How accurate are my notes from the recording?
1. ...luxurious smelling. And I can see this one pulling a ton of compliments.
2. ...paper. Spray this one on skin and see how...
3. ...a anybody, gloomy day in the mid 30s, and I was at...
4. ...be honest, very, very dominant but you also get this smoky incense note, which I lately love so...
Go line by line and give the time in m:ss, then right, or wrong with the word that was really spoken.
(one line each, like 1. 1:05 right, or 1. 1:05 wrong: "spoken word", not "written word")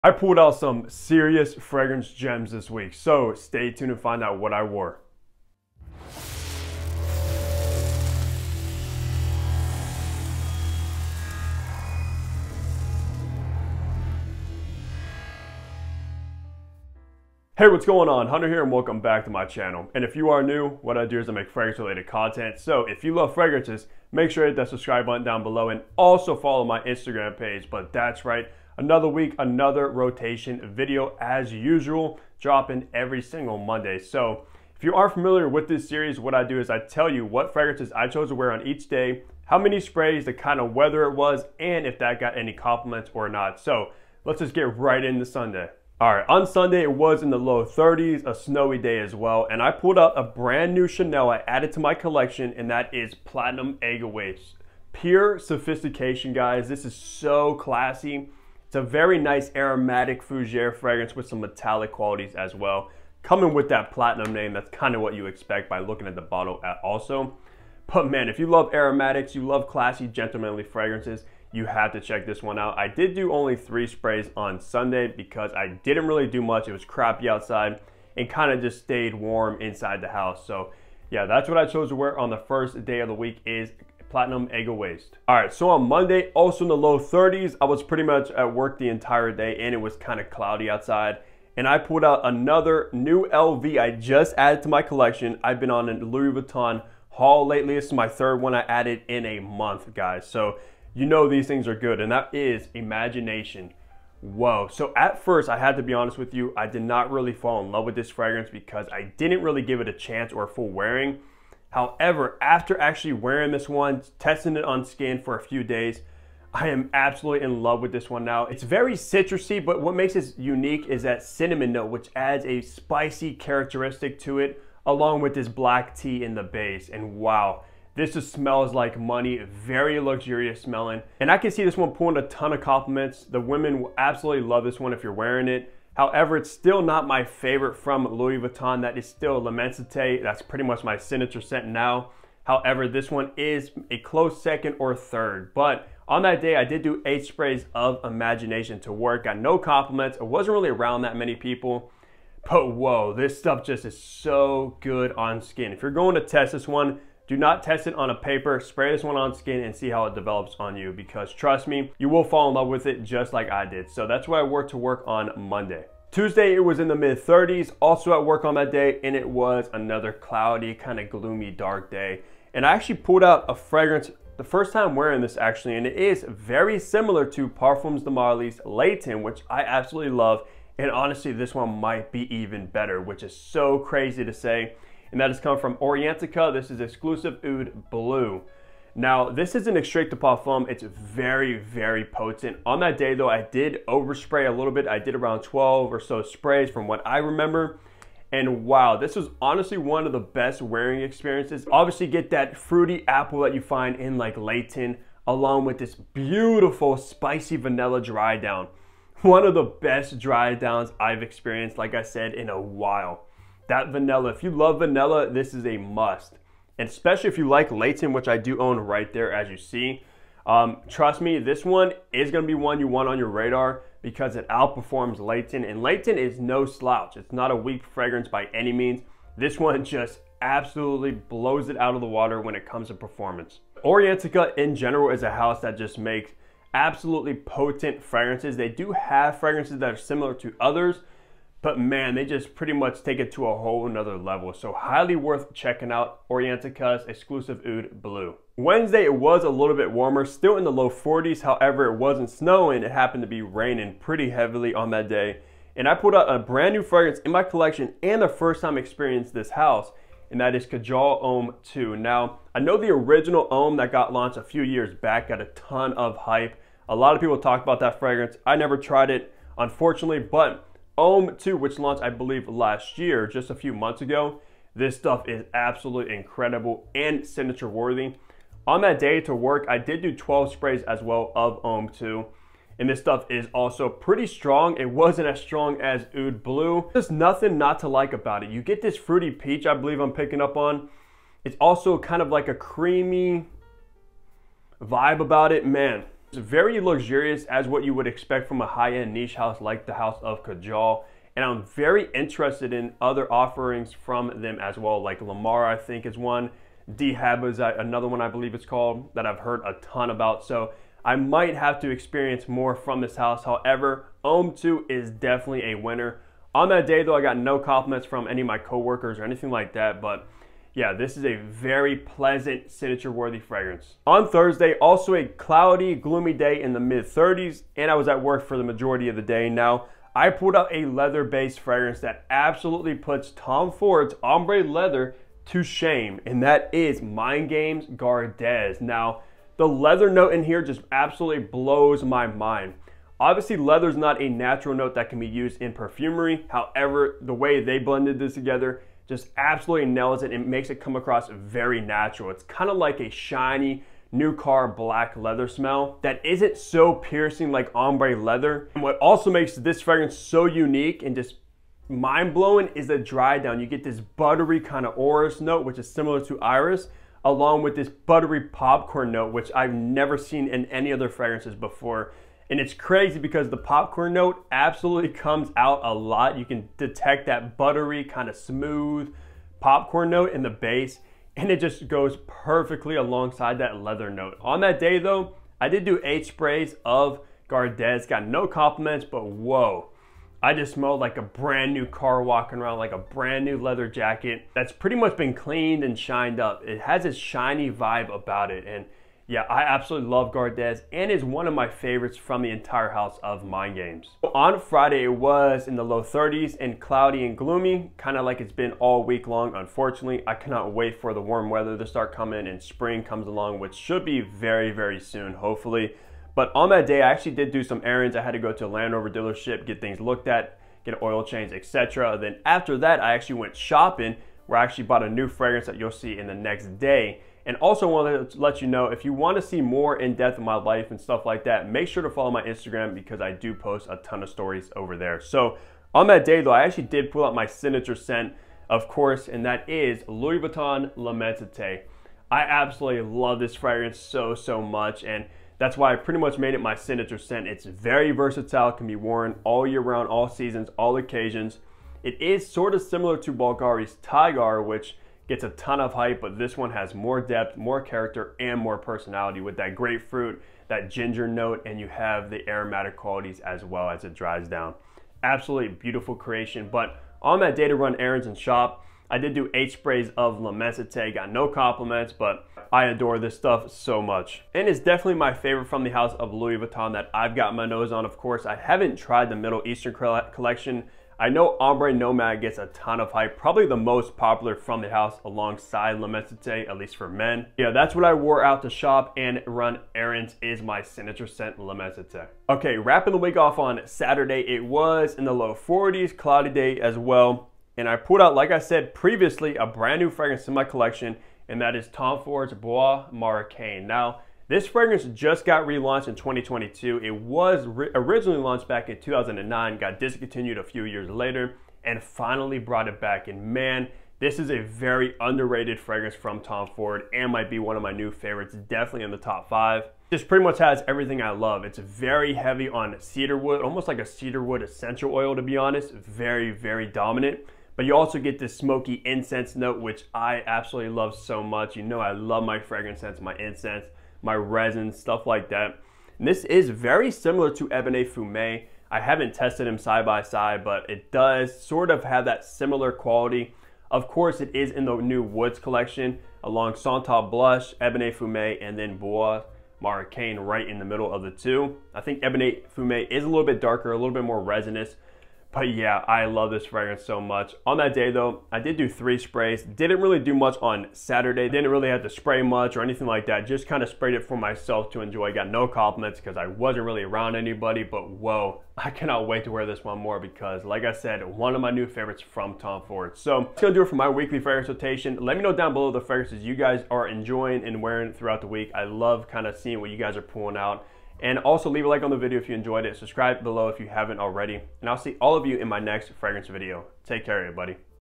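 1. 2:10 right
2. 2:38 right
3. 5:25 wrong: "cloudy", not "anybody"
4. 8:45 wrong: "absolutely", not "lately".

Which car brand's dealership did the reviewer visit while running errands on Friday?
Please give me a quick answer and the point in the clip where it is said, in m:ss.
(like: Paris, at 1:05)
Land Rover, at 6:58.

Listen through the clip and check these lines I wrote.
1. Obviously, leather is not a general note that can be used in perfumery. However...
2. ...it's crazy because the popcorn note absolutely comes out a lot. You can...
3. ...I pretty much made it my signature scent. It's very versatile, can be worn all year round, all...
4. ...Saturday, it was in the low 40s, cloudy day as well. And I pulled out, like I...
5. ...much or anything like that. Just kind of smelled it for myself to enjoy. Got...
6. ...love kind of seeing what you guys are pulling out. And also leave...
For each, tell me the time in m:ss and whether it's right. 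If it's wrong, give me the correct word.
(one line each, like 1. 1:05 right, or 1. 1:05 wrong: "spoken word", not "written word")
1. 5:43 wrong: "natural", not "general"
2. 6:12 right
3. 7:25 right
4. 8:13 right
5. 9:22 wrong: "sprayed", not "smelled"
6. 9:38 right.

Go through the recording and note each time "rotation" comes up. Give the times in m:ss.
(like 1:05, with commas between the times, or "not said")
0:29, 9:34.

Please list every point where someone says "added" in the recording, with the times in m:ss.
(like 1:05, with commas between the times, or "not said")
0:51, 1:34, 1:38.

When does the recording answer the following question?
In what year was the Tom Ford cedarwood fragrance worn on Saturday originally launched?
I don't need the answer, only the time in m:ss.
8:28.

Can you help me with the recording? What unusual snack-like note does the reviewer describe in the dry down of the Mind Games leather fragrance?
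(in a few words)
buttery popcorn.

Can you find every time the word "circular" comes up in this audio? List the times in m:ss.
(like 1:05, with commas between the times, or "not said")
not said.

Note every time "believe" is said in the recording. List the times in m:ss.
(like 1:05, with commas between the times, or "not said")
4:32, 4:49, 5:08.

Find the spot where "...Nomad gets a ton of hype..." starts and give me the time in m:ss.
8:01.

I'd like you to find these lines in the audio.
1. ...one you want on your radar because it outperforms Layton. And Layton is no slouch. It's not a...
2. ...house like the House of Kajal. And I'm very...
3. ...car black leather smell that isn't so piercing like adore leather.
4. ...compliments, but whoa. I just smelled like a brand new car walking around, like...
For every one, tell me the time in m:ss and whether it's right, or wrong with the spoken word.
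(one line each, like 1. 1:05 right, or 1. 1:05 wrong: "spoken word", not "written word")
1. 3:42 right
2. 4:59 right
3. 5:54 wrong: "ombre", not "adore"
4. 6:28 right.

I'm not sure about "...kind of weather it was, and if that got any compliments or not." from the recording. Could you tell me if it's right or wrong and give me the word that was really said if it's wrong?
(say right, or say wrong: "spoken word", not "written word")
right.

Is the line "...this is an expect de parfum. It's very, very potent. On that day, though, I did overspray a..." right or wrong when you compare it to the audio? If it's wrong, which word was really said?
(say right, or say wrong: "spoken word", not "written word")
wrong: "extract", not "expect".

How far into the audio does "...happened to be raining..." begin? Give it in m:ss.
4:12.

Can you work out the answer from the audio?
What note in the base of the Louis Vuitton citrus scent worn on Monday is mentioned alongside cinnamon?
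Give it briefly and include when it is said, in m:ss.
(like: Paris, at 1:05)
black tea, at 2:05.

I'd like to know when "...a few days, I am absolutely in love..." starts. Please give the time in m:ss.
1:55.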